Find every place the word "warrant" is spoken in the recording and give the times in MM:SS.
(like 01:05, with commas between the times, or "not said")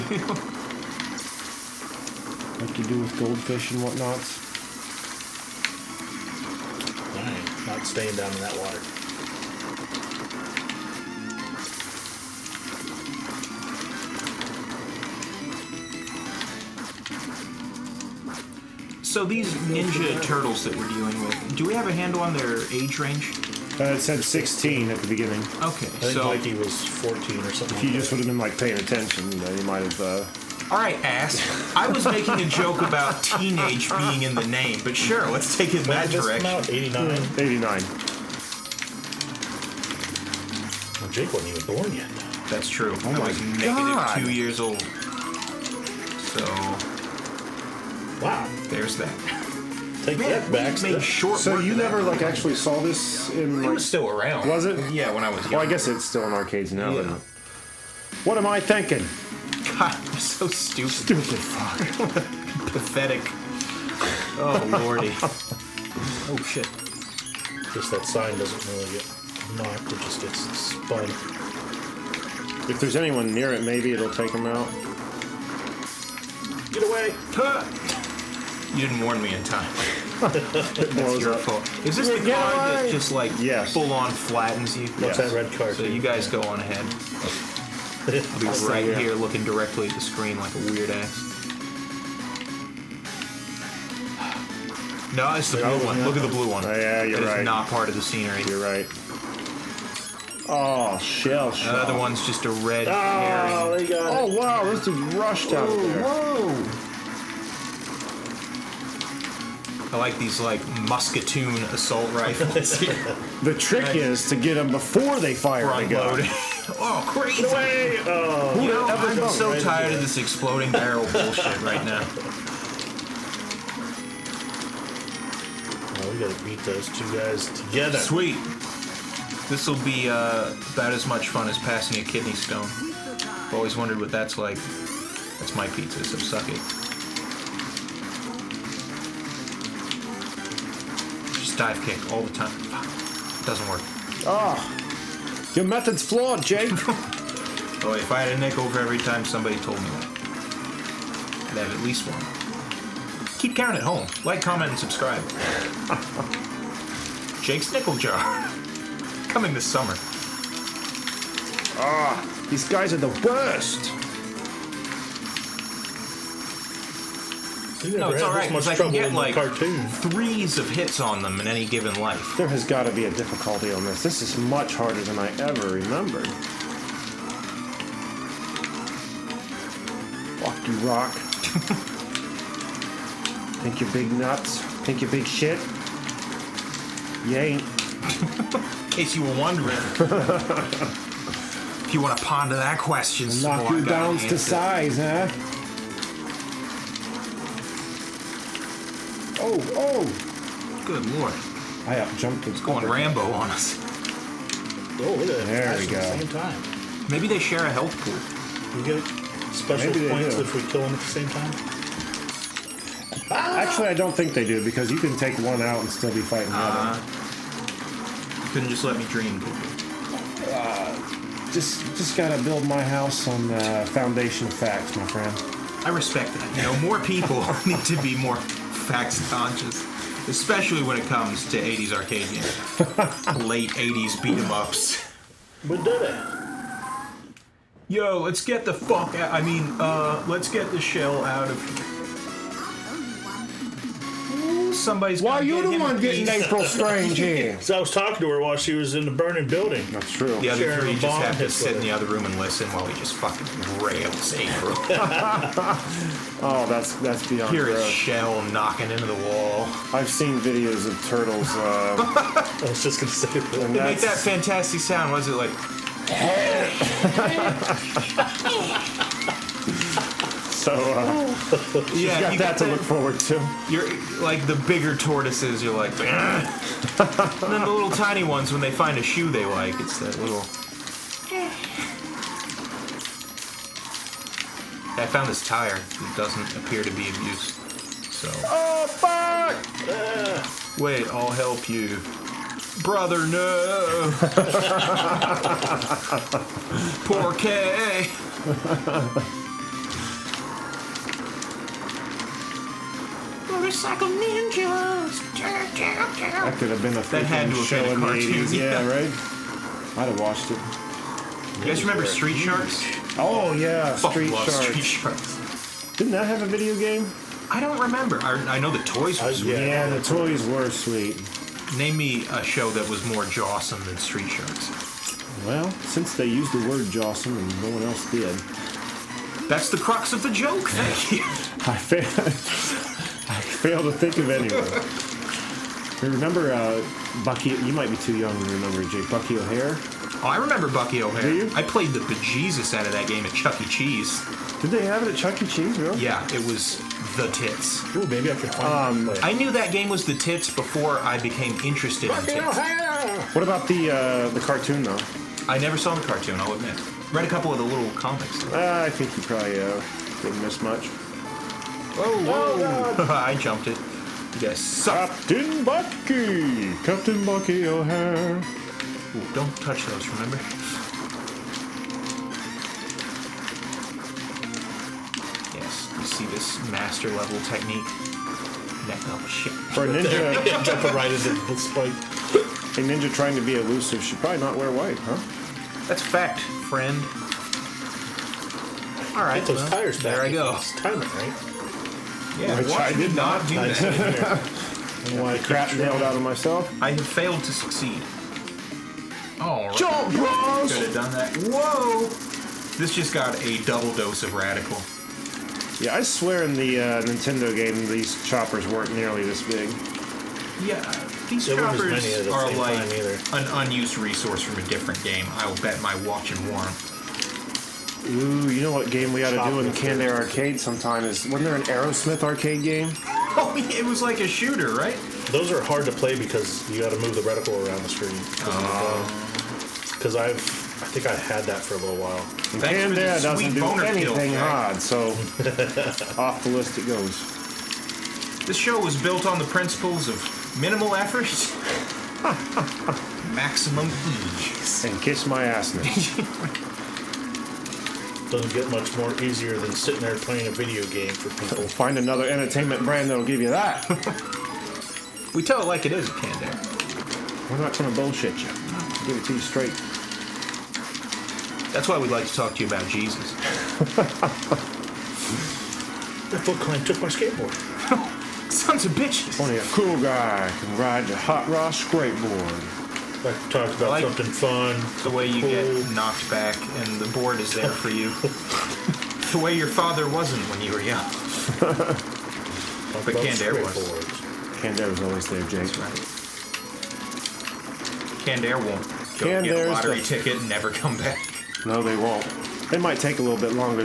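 06:56.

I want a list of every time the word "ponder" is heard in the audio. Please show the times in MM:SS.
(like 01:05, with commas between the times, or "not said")
03:12.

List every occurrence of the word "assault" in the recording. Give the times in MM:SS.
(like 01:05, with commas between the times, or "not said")
01:51.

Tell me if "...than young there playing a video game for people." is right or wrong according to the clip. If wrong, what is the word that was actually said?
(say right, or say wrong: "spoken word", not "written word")
wrong: "sitting", not "young".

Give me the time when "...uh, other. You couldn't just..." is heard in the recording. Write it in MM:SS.
03:36.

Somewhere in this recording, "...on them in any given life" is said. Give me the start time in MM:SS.
02:50.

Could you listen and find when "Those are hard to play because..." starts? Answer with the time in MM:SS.
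07:05.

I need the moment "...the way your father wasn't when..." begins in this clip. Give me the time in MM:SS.
07:59.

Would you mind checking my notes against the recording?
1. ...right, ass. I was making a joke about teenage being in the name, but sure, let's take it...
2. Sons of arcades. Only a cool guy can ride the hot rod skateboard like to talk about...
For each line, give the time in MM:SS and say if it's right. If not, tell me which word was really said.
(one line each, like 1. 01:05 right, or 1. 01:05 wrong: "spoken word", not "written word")
1. 00:30 right
2. 07:48 wrong: "bitches", not "arcades".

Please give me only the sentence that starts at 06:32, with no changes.
Yeah, which I did not do this.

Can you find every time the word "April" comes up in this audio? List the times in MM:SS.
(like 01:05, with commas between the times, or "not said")
04:06, 04:14.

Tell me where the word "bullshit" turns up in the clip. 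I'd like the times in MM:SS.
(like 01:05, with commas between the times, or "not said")
02:01, 07:37.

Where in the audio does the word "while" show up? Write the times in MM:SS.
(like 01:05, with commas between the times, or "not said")
04:08, 04:12, 07:11.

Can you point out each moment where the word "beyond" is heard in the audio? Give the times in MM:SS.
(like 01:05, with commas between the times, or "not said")
04:17.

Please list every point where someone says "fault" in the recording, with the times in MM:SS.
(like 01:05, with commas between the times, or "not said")
01:21.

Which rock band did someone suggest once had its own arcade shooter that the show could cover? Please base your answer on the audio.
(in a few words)
Aerosmith.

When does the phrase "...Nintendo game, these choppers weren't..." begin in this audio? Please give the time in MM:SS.
06:47.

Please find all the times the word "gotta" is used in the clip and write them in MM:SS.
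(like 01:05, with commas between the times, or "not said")
02:06, 03:42.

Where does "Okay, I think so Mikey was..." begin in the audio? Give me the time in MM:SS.
00:25.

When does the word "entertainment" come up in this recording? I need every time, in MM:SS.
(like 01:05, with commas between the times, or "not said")
07:32.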